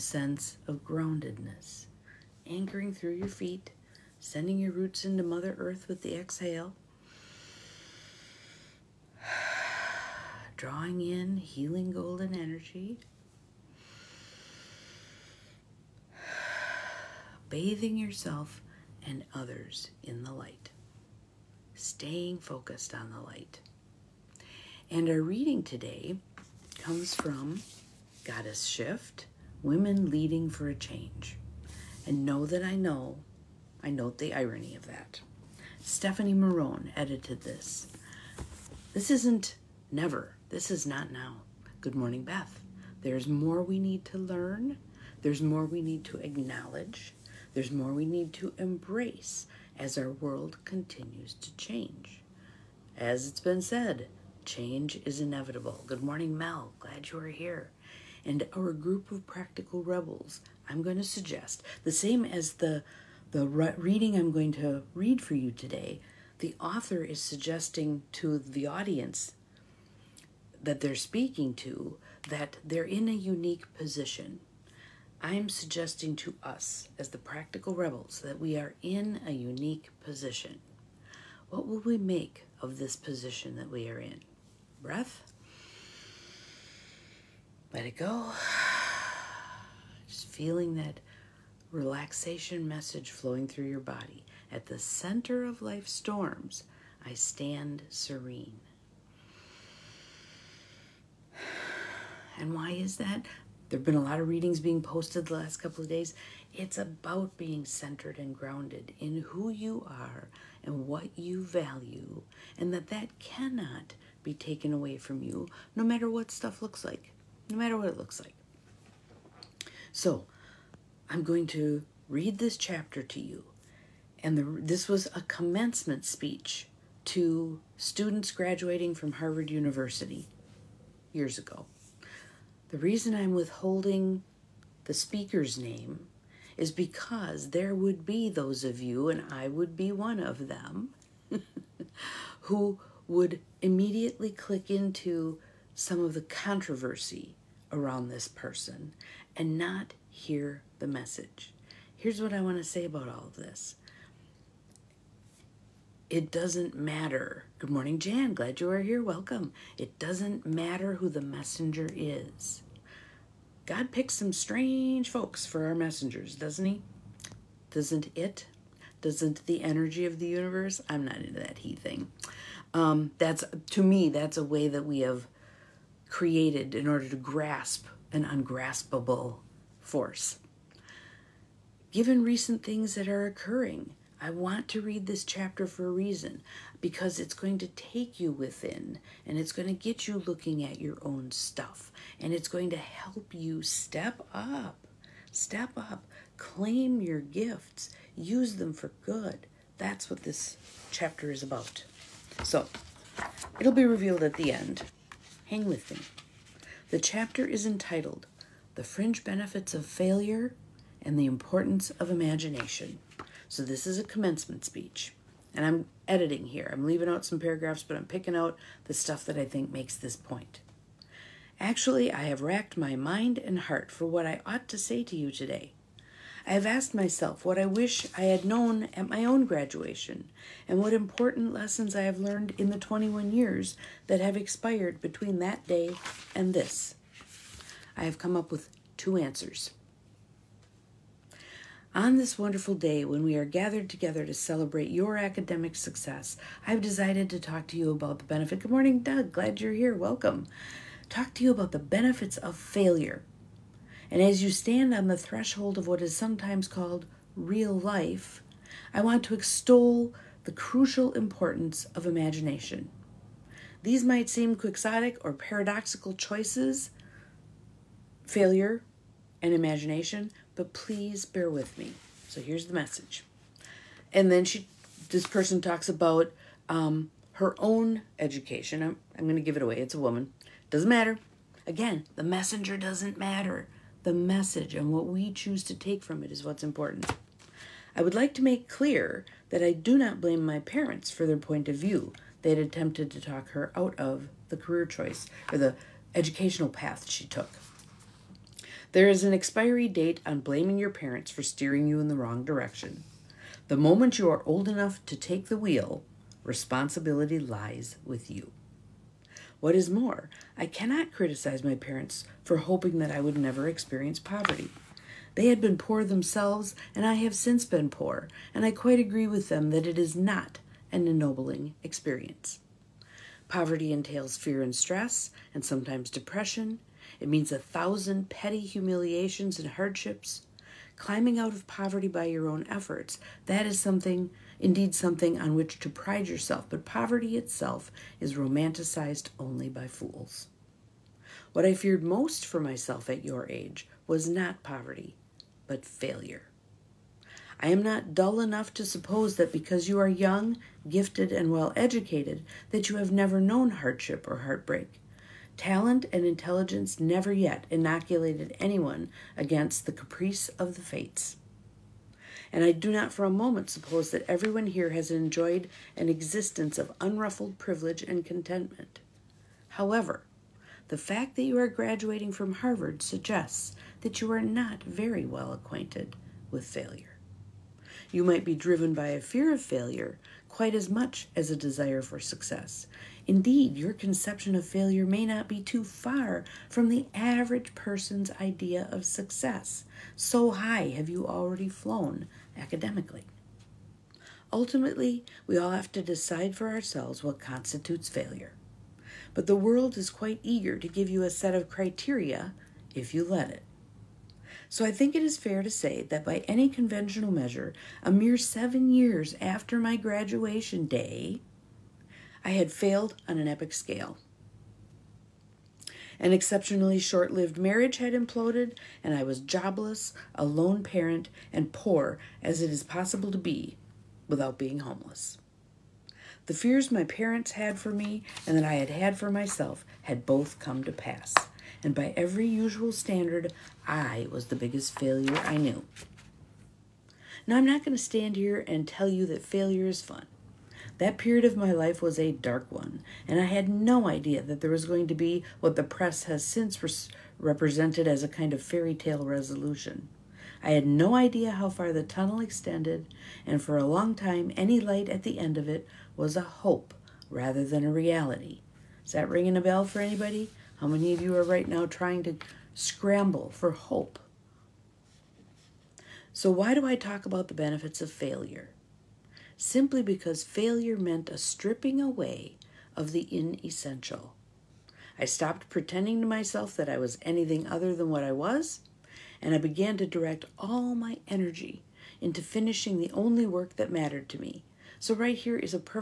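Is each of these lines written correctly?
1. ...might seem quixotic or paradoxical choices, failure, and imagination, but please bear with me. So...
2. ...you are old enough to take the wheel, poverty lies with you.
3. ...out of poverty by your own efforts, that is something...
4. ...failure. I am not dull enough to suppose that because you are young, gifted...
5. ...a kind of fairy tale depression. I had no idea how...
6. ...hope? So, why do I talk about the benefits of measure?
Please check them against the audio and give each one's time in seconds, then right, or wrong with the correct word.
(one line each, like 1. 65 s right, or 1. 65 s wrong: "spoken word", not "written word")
1. 264 s right
2. 304 s wrong: "responsibility", not "poverty"
3. 331 s right
4. 345 s right
5. 448 s wrong: "resolution", not "depression"
6. 463 s wrong: "failure", not "measure".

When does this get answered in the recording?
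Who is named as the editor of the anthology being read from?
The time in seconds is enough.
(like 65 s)
35 s.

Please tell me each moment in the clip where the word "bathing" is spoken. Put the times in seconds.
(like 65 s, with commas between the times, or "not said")
17 s.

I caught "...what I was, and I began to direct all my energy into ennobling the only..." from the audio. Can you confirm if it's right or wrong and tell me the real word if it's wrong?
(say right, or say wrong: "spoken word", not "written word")
wrong: "finishing", not "ennobling".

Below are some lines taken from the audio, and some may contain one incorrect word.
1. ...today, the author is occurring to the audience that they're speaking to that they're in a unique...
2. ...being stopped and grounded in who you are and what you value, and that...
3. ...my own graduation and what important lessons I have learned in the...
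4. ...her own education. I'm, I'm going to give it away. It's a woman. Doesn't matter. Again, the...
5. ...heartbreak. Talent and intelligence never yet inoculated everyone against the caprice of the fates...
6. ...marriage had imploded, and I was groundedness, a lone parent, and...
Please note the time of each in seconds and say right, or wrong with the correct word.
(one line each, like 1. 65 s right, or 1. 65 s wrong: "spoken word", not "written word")
1. 65 s wrong: "suggesting", not "occurring"
2. 107 s wrong: "centered", not "stopped"
3. 229 s right
4. 277 s right
5. 354 s wrong: "anyone", not "everyone"
6. 417 s wrong: "jobless", not "groundedness".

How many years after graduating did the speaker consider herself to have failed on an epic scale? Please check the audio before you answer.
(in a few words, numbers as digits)
7.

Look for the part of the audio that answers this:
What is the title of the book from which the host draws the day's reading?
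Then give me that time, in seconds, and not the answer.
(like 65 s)
28 s.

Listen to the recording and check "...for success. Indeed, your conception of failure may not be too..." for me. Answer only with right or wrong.
right.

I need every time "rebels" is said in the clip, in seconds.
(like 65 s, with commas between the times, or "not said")
59 s, 77 s.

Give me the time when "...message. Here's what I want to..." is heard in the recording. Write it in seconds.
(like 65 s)
150 s.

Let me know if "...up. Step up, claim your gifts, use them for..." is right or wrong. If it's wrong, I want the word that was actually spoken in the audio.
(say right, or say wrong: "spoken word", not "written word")
right.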